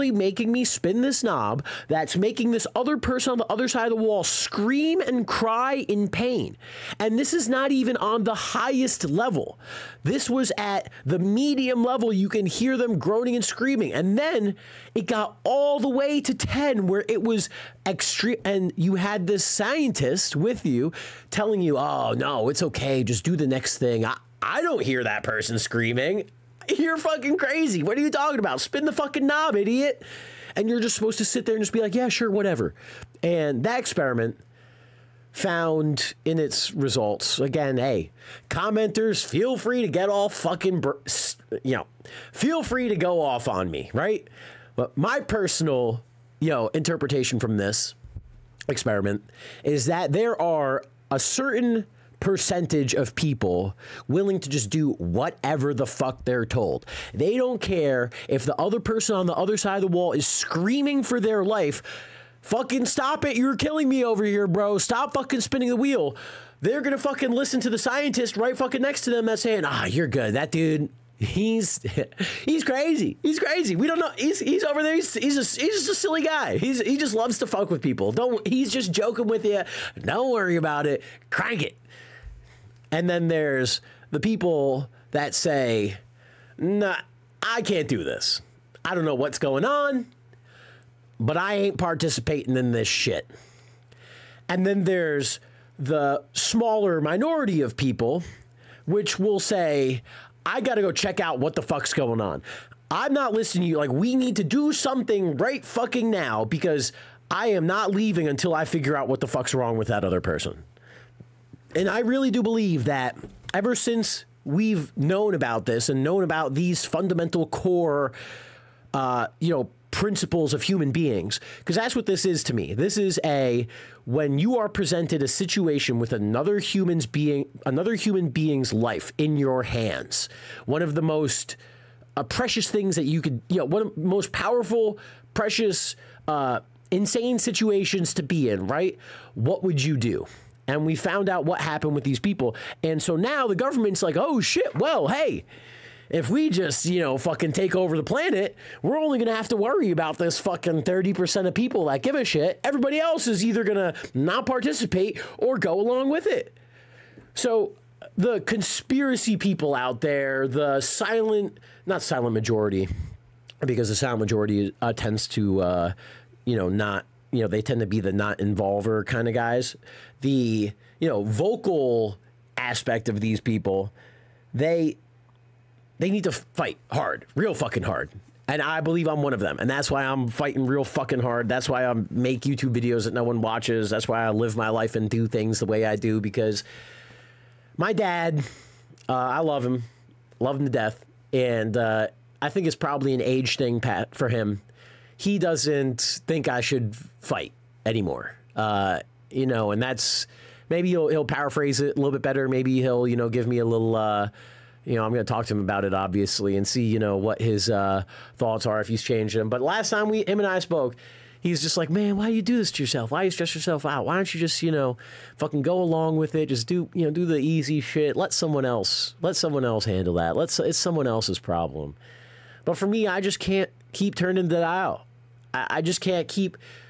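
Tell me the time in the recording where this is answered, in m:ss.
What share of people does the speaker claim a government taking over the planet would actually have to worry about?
2:30.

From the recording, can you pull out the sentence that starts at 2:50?
The, you know, vocal aspect of these people, they they need to fight hard, real fucking hard.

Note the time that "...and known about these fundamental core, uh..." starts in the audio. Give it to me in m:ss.
1:55.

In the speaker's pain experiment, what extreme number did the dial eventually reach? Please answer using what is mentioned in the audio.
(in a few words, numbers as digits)
10.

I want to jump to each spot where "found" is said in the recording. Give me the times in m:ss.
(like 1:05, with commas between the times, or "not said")
0:35, 2:20.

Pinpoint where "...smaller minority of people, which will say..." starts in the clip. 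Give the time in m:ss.
1:36.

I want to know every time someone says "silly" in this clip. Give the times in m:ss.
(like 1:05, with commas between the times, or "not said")
1:15.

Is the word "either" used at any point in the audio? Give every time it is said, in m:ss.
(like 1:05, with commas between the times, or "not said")
2:33.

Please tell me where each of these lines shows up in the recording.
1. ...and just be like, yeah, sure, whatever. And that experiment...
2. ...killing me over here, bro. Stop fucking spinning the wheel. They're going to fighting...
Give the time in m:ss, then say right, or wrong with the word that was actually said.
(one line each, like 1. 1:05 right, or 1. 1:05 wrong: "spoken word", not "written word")
1. 0:31 right
2. 1:03 wrong: "fucking", not "fighting".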